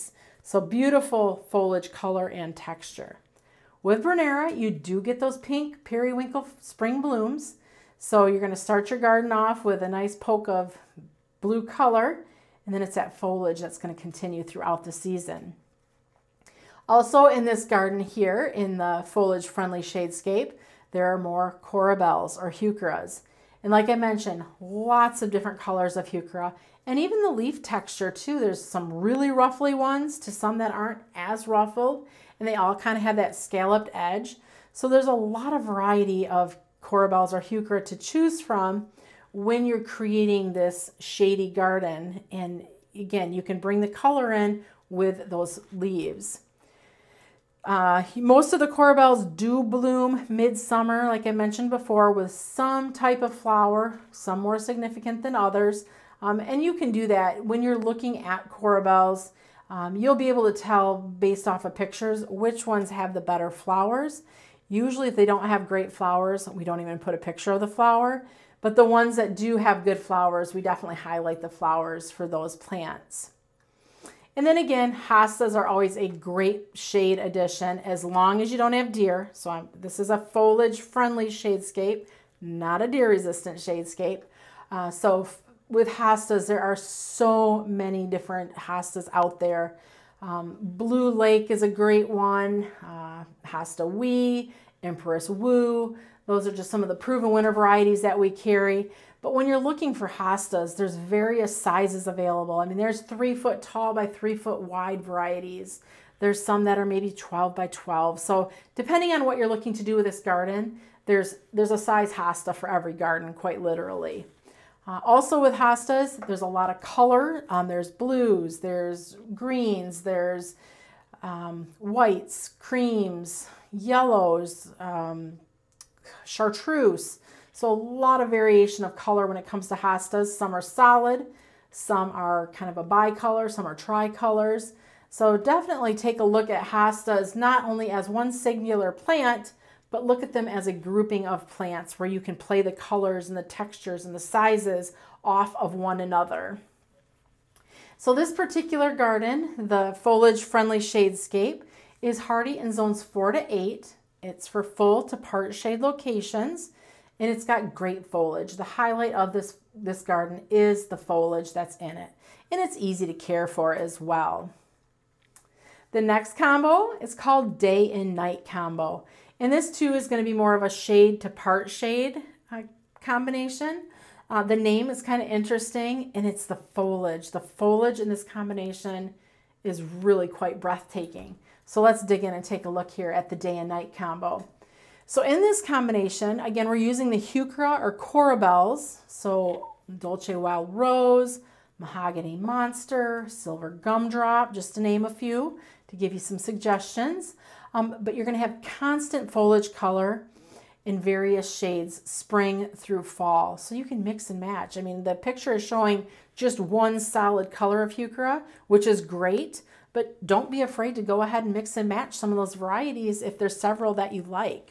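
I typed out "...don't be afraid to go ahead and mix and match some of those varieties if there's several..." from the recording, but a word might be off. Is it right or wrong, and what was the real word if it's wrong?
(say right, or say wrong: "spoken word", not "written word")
right.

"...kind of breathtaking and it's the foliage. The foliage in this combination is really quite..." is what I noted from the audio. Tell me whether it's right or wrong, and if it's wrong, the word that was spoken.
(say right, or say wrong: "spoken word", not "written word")
wrong: "interesting", not "breathtaking".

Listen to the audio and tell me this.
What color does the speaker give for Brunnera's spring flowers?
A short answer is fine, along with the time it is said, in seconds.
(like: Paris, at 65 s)
Pink periwinkle, at 5 s.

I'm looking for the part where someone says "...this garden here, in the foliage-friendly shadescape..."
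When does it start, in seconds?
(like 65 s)
17 s.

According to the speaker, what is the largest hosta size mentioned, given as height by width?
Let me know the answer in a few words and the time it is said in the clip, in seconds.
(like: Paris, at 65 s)
3 feet by 3 feet, at 103 s.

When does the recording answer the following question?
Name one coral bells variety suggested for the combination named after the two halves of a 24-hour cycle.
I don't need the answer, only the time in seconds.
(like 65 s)
191 s.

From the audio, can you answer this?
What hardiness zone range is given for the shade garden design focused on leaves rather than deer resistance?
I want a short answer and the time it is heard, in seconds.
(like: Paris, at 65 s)
Zones 4 to 8, at 152 s.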